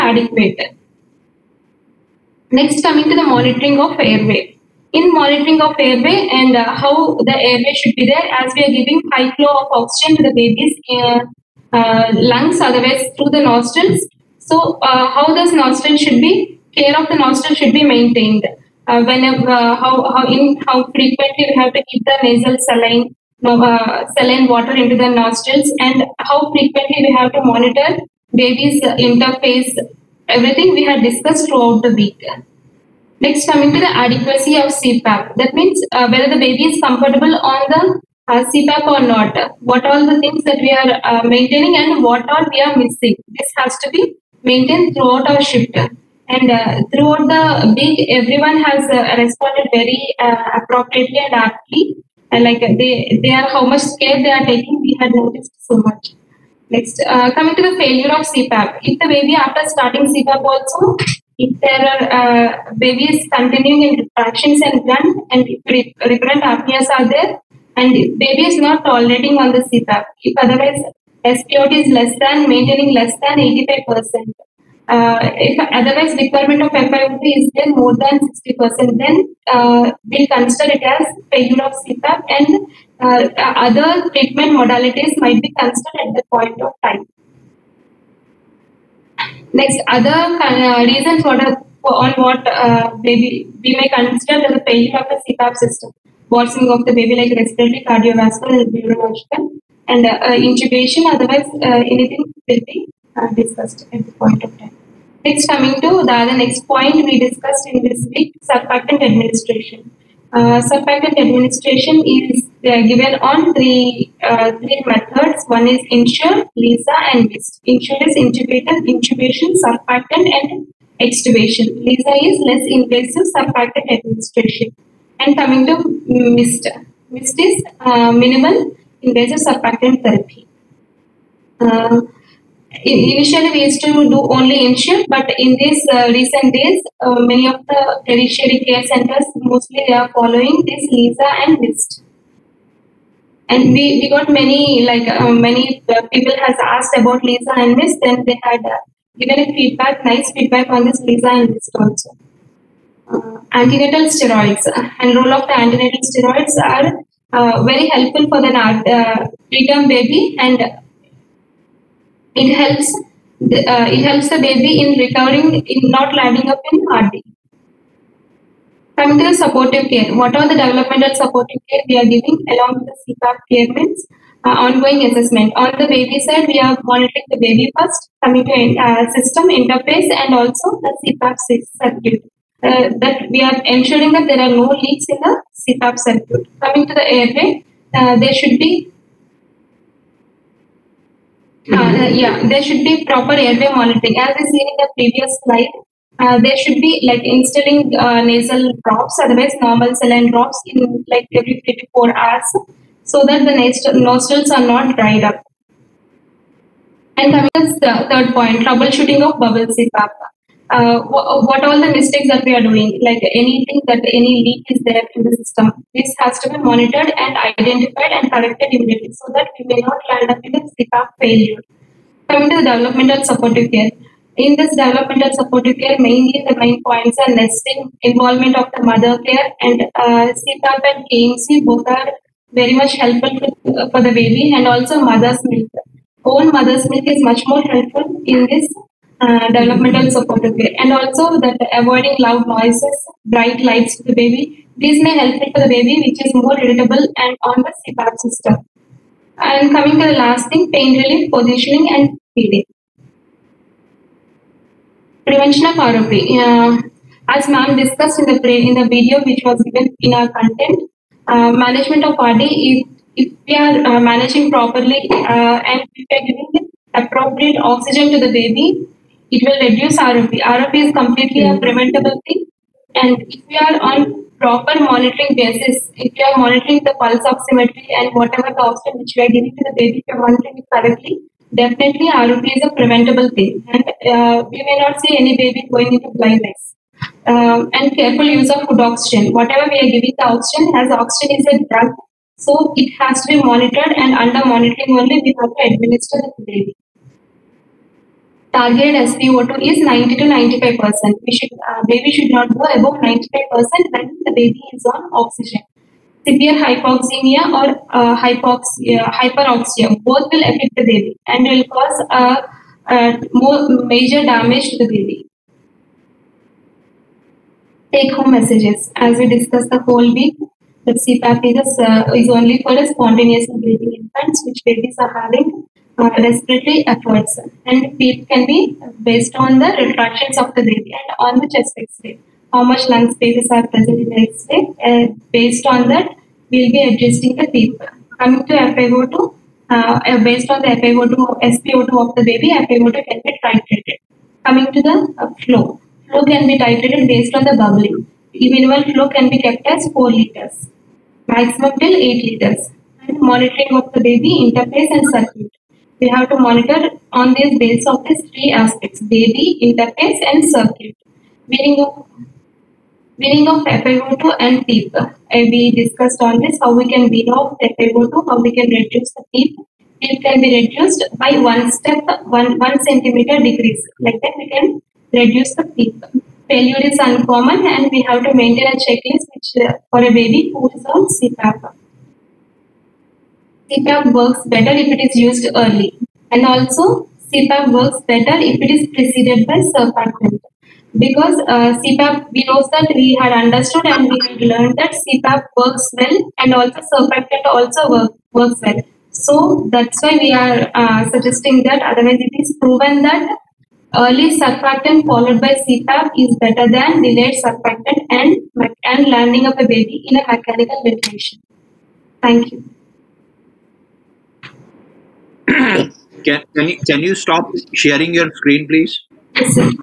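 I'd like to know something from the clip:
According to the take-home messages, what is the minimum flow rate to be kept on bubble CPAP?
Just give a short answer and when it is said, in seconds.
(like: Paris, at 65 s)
4 liters, at 349 s.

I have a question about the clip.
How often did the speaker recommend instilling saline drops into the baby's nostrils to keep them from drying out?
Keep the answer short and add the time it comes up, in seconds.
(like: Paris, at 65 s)
every 3 to 4 hours, at 201 s.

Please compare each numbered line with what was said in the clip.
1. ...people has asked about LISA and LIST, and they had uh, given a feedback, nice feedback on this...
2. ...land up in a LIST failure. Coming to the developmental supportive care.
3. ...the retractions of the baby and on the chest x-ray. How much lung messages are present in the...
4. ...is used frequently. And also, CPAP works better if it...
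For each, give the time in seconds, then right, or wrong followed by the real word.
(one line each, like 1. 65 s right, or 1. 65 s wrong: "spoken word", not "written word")
1. 146 s right
2. 220 s wrong: "CPAP", not "LIST"
3. 329 s wrong: "spaces", not "messages"
4. 385 s wrong: "early", not "frequently".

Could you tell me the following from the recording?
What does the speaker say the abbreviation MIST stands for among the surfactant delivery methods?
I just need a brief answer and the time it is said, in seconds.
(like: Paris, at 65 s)
minimal invasive surfactant therapy, at 128 s.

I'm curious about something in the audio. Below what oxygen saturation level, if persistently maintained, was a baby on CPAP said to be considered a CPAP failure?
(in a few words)
85%.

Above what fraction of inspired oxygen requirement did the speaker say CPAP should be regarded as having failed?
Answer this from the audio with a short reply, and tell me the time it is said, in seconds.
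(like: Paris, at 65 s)
60%, at 78 s.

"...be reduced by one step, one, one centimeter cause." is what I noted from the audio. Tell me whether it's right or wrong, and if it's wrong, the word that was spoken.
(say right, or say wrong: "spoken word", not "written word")
wrong: "decrease", not "cause".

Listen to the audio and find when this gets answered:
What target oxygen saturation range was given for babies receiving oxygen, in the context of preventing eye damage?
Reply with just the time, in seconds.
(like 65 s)
299 s.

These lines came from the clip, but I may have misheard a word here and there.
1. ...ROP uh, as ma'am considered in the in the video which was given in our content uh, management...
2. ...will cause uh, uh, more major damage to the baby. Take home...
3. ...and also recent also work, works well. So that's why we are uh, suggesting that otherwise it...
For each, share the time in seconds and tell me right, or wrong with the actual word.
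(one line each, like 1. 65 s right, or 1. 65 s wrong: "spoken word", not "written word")
1. 255 s wrong: "discussed", not "considered"
2. 311 s right
3. 396 s wrong: "surfactant", not "recent".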